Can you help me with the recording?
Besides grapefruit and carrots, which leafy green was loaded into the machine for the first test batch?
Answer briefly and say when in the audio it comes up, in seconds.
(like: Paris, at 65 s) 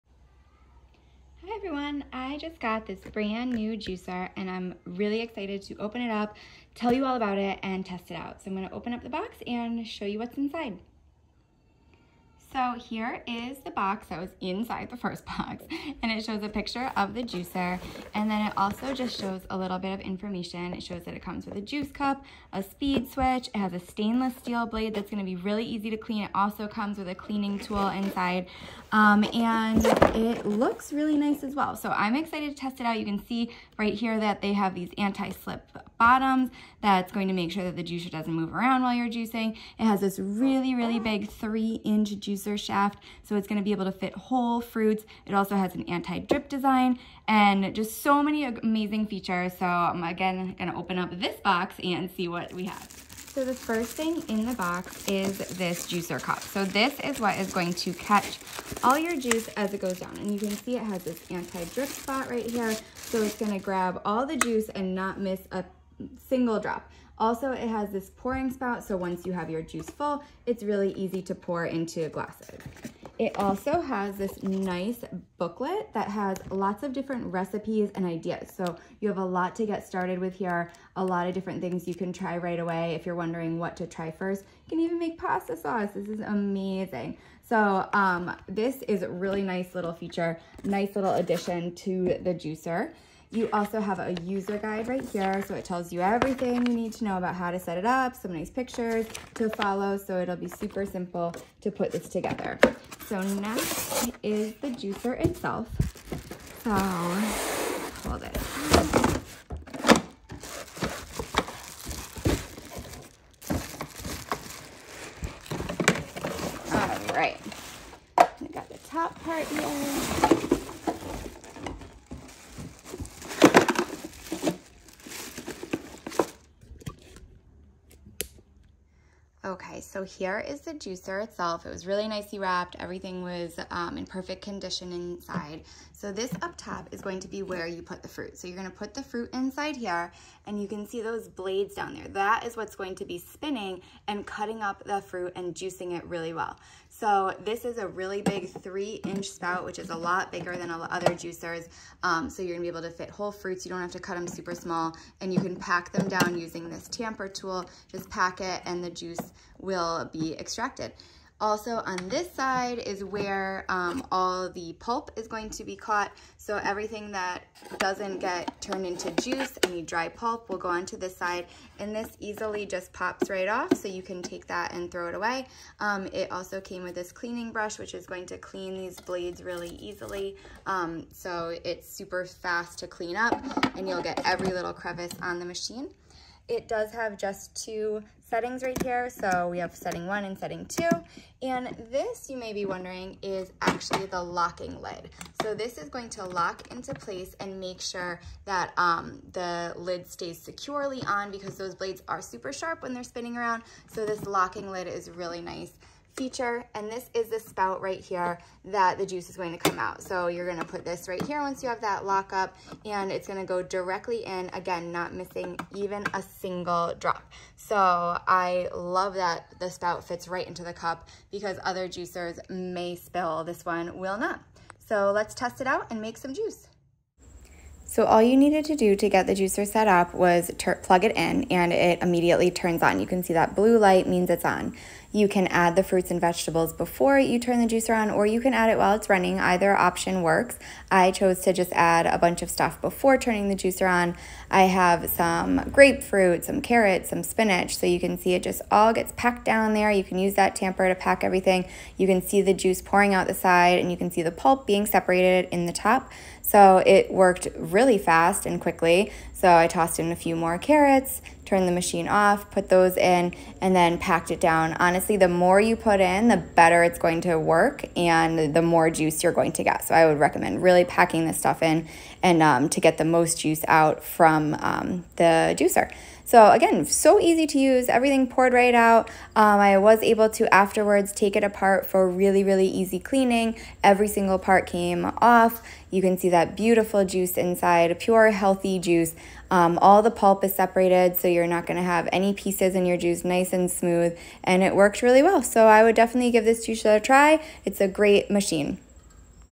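Spinach, at 247 s.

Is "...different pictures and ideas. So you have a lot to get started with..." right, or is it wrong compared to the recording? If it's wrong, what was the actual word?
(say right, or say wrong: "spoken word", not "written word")
wrong: "recipes", not "pictures".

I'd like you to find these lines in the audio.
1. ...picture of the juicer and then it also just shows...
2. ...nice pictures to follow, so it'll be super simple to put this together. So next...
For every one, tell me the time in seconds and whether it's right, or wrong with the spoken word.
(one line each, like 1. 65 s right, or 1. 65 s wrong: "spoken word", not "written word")
1. 16 s right
2. 98 s right.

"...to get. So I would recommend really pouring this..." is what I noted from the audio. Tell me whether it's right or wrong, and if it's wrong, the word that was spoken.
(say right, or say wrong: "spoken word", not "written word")
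wrong: "packing", not "pouring".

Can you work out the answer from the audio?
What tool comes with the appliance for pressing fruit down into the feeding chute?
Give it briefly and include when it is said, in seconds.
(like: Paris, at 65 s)
Tamper tool, at 156 s.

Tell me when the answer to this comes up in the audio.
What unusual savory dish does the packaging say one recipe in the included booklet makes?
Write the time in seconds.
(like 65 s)
85 s.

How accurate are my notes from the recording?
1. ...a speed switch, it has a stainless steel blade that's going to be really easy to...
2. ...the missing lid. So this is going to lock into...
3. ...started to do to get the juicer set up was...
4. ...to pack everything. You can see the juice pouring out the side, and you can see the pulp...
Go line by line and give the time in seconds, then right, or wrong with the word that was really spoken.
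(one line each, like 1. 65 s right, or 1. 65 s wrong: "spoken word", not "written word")
1. 22 s right
2. 194 s wrong: "locking", not "missing"
3. 228 s wrong: "needed", not "started"
4. 250 s right.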